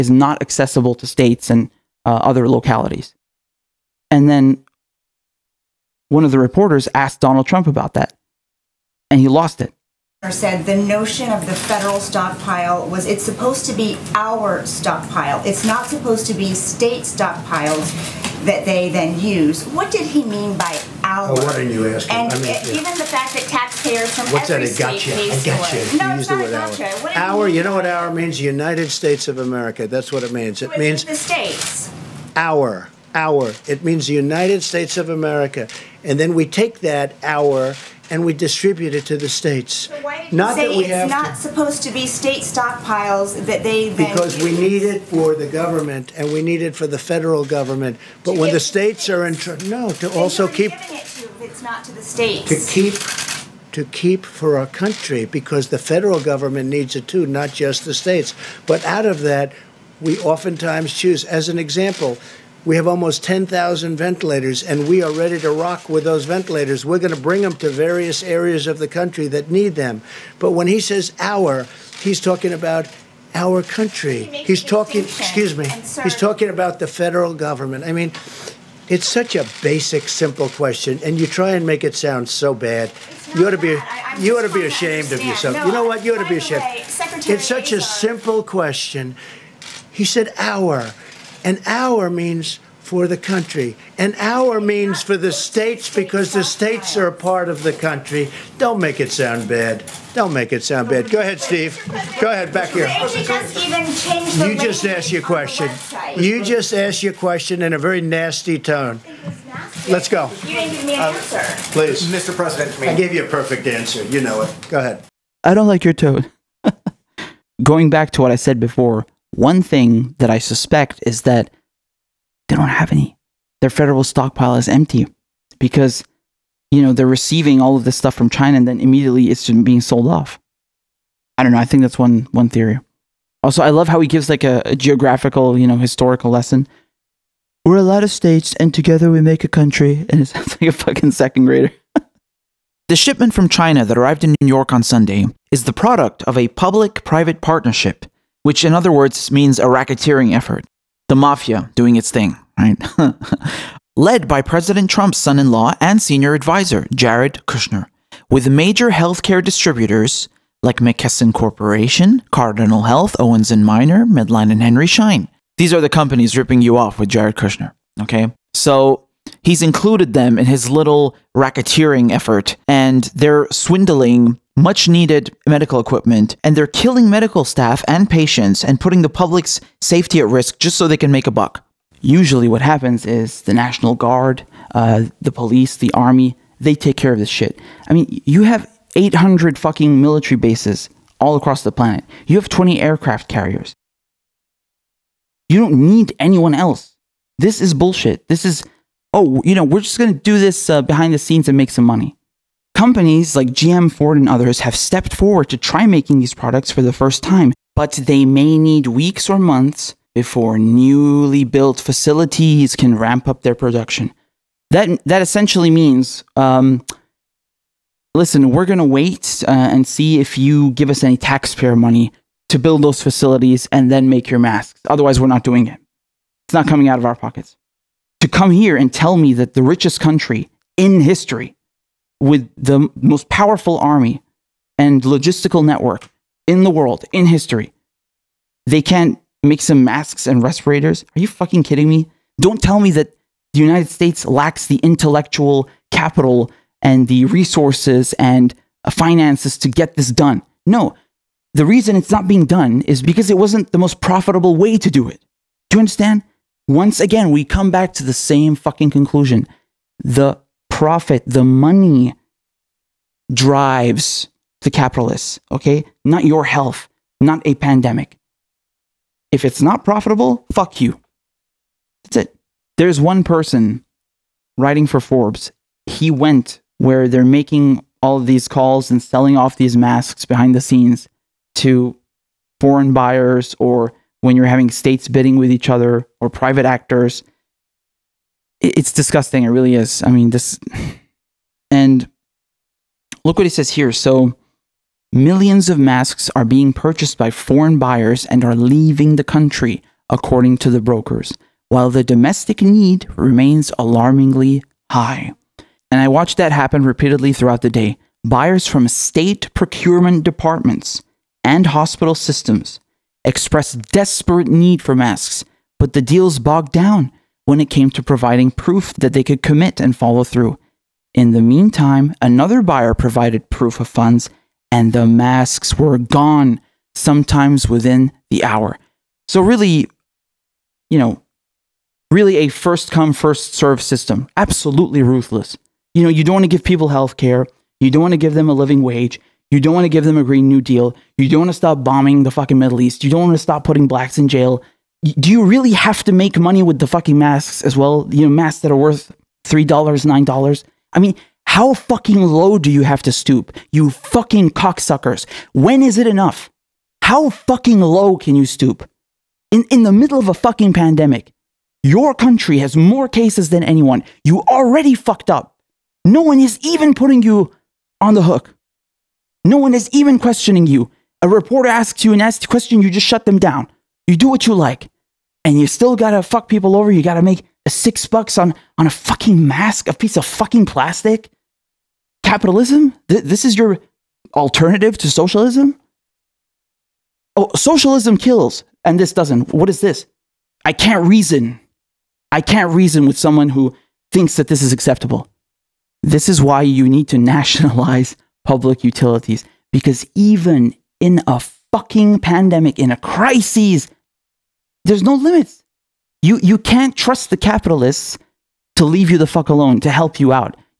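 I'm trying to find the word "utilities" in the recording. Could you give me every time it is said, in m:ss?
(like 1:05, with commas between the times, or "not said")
6:38.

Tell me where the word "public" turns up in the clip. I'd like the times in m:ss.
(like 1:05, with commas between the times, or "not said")
2:26, 2:59, 6:38.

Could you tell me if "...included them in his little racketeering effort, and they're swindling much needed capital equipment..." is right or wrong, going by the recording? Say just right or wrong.
wrong.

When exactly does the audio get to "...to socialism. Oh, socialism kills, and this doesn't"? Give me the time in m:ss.
6:24.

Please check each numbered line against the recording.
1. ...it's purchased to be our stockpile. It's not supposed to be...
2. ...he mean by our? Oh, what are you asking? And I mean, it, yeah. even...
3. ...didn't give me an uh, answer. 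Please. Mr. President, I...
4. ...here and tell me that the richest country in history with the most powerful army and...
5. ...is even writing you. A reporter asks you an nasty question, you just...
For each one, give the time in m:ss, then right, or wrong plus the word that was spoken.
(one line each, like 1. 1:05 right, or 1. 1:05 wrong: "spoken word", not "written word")
1. 0:13 wrong: "supposed", not "purchased"
2. 0:20 right
3. 1:50 right
4. 3:48 right
5. 6:09 wrong: "questioning", not "writing".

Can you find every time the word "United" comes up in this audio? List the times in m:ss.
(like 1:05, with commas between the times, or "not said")
0:28, 0:34, 4:03.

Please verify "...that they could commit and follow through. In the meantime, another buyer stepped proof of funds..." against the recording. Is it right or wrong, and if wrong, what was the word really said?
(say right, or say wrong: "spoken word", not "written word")
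wrong: "provided", not "stepped".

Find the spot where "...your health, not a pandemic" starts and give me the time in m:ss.
4:26.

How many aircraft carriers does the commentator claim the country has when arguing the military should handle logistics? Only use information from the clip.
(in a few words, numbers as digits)
20.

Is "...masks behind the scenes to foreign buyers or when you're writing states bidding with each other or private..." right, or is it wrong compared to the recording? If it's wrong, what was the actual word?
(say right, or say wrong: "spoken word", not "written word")
wrong: "having", not "writing".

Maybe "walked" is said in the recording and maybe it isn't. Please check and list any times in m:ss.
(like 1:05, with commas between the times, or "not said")
not said.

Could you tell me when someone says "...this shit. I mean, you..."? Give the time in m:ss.
3:07.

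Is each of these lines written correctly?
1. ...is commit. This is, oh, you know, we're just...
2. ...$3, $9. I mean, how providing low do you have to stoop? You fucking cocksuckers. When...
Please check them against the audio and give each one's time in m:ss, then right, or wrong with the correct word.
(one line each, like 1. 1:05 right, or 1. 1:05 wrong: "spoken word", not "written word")
1. 3:17 wrong: "bullshit", not "commit"
2. 5:49 wrong: "fucking", not "providing".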